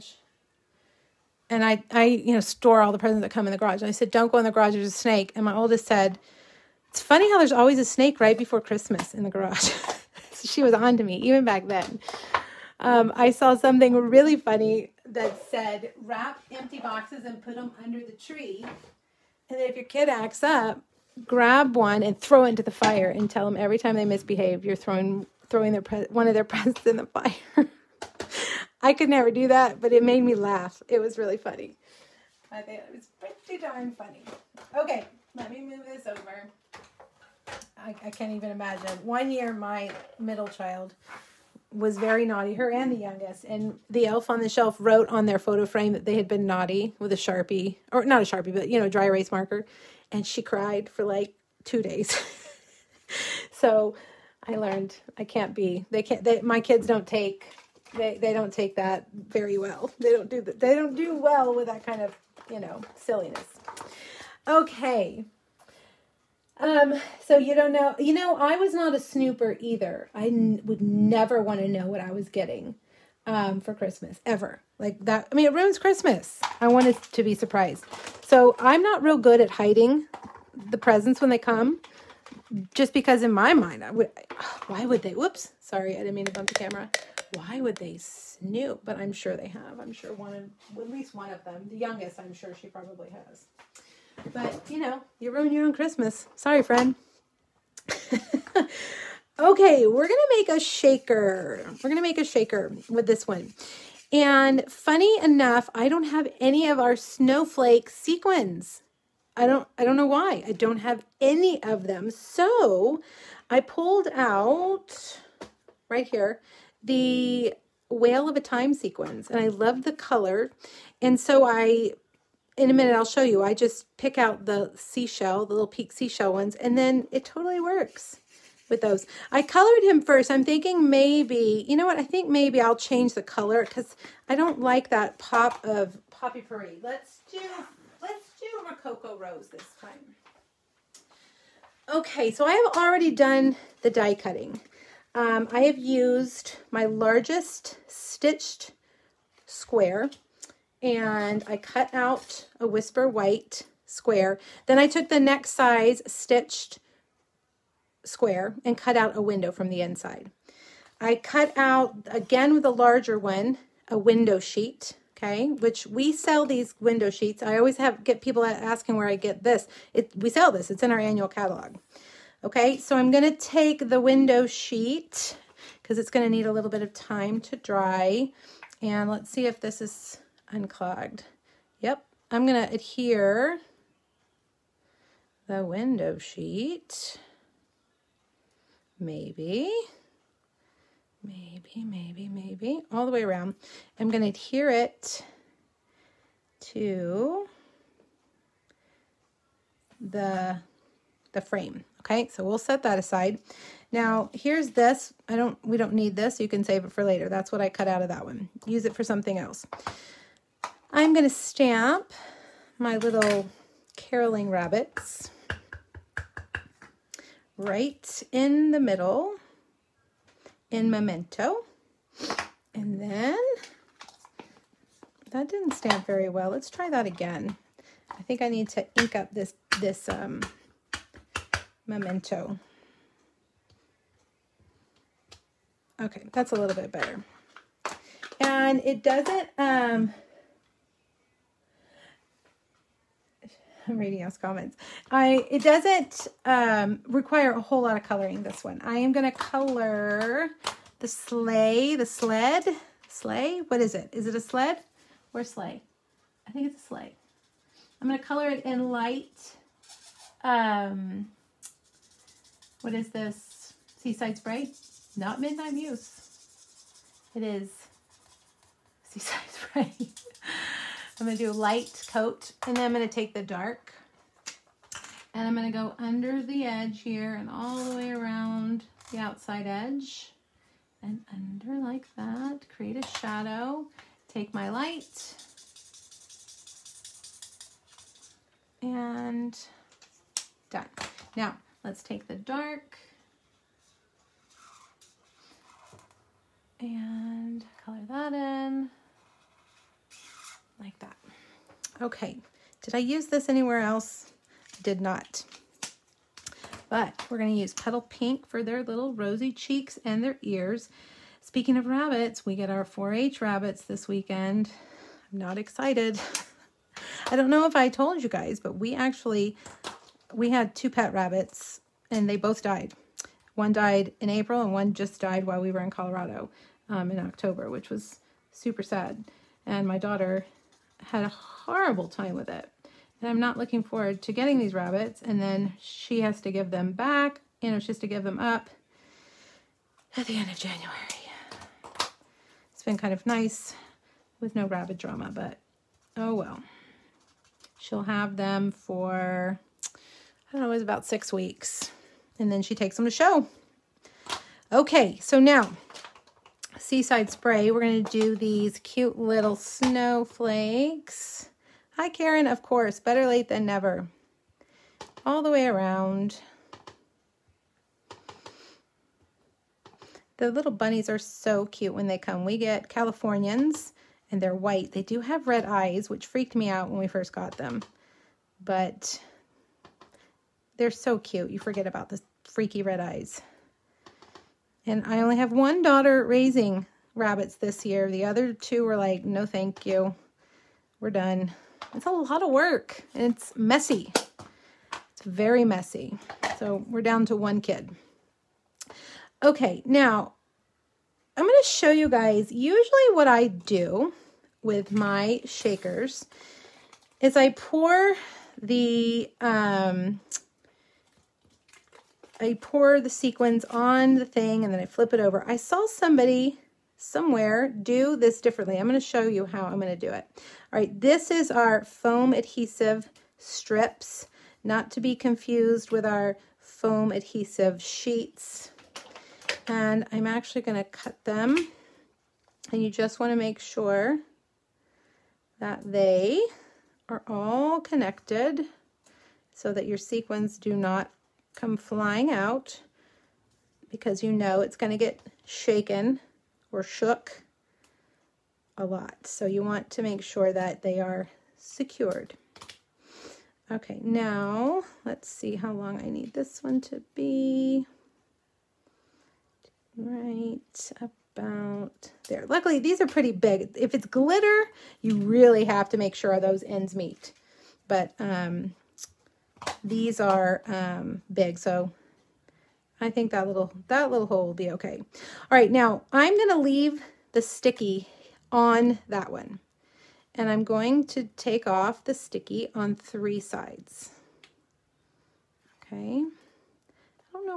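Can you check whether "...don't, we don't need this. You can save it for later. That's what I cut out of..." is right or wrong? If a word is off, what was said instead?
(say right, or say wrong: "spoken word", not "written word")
right.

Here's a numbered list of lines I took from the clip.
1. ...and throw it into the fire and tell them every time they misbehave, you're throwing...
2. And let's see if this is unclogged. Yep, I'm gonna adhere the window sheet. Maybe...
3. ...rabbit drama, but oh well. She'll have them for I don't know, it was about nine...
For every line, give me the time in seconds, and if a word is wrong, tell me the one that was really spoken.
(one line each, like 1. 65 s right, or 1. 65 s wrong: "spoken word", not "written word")
1. 22 s right
2. 178 s right
3. 344 s wrong: "six", not "nine".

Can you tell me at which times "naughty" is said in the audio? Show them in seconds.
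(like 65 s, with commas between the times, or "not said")
42 s, 46 s.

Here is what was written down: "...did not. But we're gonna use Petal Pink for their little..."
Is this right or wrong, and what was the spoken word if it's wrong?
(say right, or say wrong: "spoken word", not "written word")
right.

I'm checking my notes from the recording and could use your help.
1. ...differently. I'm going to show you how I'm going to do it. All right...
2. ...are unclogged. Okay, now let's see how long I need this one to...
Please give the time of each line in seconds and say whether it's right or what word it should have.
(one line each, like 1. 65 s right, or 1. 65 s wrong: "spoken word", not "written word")
1. 418 s right
2. 451 s wrong: "secured", not "unclogged".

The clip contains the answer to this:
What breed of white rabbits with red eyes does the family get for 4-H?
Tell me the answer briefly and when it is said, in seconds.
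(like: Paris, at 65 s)
Californians, at 372 s.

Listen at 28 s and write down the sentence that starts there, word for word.
I could never do that, but it made me laugh.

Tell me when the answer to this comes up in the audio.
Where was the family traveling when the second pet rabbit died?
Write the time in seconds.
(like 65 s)
325 s.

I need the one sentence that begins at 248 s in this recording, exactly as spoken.
I am going to color the sleigh, the sled, sleigh.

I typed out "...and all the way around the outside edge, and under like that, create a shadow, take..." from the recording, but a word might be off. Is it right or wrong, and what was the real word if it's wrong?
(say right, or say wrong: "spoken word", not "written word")
right.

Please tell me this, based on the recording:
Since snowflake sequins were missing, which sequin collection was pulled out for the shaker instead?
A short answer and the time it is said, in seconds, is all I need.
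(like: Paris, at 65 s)
Whale of a Time, at 117 s.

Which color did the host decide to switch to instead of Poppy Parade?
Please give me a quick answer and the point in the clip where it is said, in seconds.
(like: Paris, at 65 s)
Rococo Rose, at 138 s.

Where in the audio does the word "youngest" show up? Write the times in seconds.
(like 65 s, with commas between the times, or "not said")
42 s, 91 s.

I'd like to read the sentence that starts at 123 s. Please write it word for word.
I just pick out the seashell, the little peak seashell ones, and then it totally works with those.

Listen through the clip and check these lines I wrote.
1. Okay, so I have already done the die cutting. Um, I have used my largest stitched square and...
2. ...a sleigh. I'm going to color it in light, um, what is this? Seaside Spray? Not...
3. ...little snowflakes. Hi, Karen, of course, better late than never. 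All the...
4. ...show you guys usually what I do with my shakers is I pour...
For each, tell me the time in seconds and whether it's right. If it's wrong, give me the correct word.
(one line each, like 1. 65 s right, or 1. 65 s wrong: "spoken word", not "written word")
1. 141 s right
2. 256 s right
3. 359 s right
4. 401 s right.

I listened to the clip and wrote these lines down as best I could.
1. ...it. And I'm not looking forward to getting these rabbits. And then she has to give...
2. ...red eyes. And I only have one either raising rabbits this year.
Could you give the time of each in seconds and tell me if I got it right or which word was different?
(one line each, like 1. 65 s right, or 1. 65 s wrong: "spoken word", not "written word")
1. 332 s right
2. 382 s wrong: "daughter", not "either".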